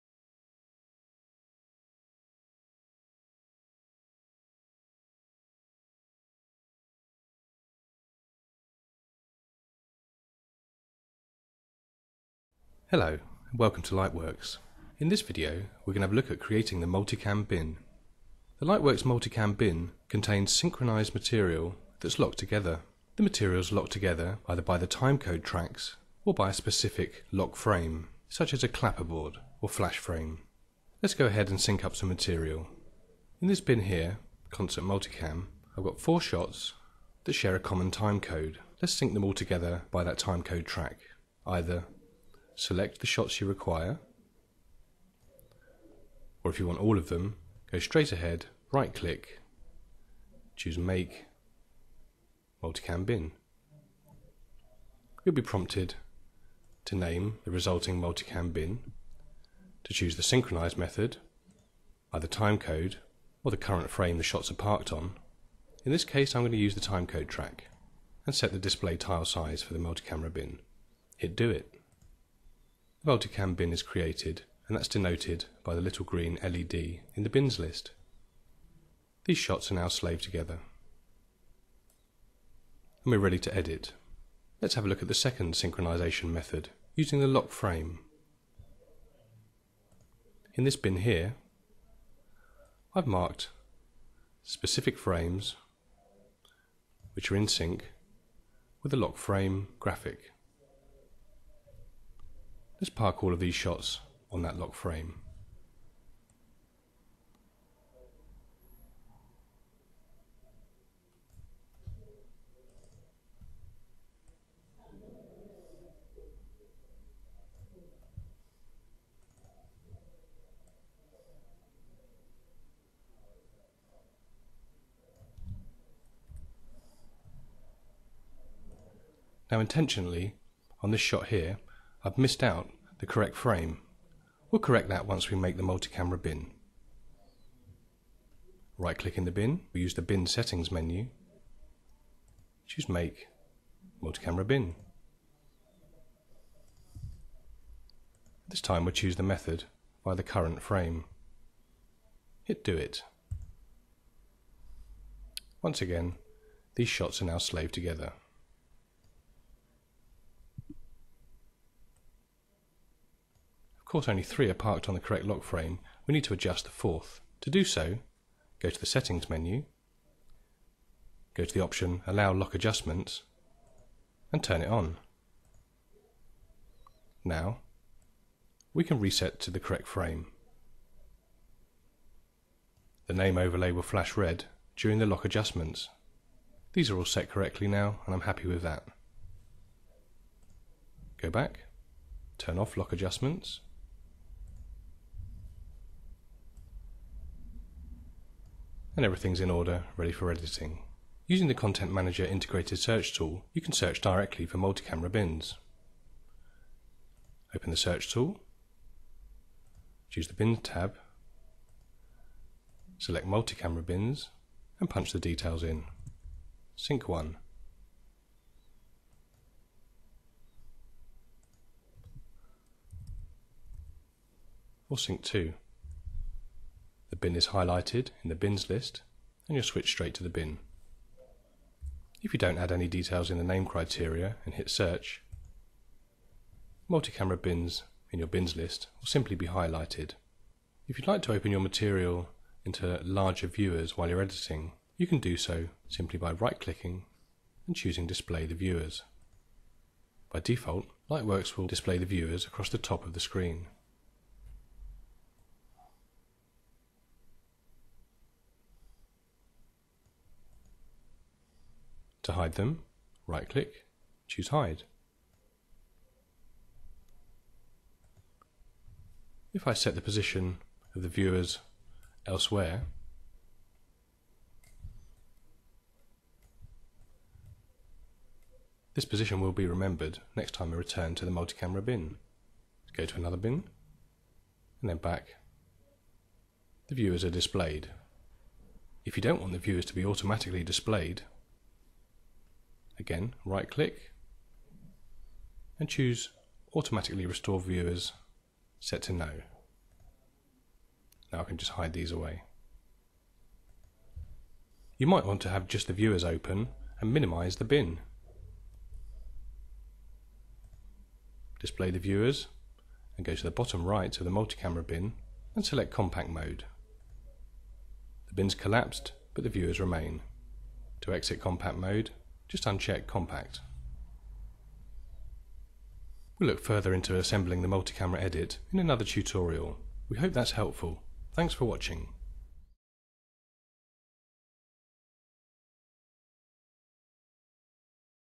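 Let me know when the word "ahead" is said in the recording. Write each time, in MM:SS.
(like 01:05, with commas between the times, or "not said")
00:31, 00:48.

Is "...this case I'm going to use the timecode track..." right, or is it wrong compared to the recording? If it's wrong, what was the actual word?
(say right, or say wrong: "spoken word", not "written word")
right.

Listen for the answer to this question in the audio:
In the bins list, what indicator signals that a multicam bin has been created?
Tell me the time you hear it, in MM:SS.
01:15.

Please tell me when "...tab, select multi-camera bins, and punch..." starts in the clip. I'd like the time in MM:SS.
03:30.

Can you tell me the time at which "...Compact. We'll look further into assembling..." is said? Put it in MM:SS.
05:23.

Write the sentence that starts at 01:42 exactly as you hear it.
Let's park all of these shots on that lock frame.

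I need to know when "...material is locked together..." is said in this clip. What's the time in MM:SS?
00:23.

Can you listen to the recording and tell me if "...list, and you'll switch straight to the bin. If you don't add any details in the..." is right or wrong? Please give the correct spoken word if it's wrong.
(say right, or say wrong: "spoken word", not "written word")
right.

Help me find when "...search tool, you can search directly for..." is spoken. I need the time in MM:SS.
03:22.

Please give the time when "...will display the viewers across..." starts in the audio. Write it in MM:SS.
04:11.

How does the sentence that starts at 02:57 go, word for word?
Now, we can reset to the correct frame.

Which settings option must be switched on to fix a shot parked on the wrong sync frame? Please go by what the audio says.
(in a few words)
Allow Lock Adjustments.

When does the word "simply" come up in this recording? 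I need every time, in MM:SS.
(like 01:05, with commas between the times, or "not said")
03:59, 04:05.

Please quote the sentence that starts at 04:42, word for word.
Go to another bin, and then back.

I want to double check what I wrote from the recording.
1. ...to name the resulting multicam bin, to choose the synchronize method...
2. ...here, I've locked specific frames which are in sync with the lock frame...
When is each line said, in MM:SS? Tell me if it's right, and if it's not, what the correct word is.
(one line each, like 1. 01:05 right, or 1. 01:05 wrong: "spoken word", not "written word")
1. 00:56 right
2. 01:30 wrong: "marked", not "locked".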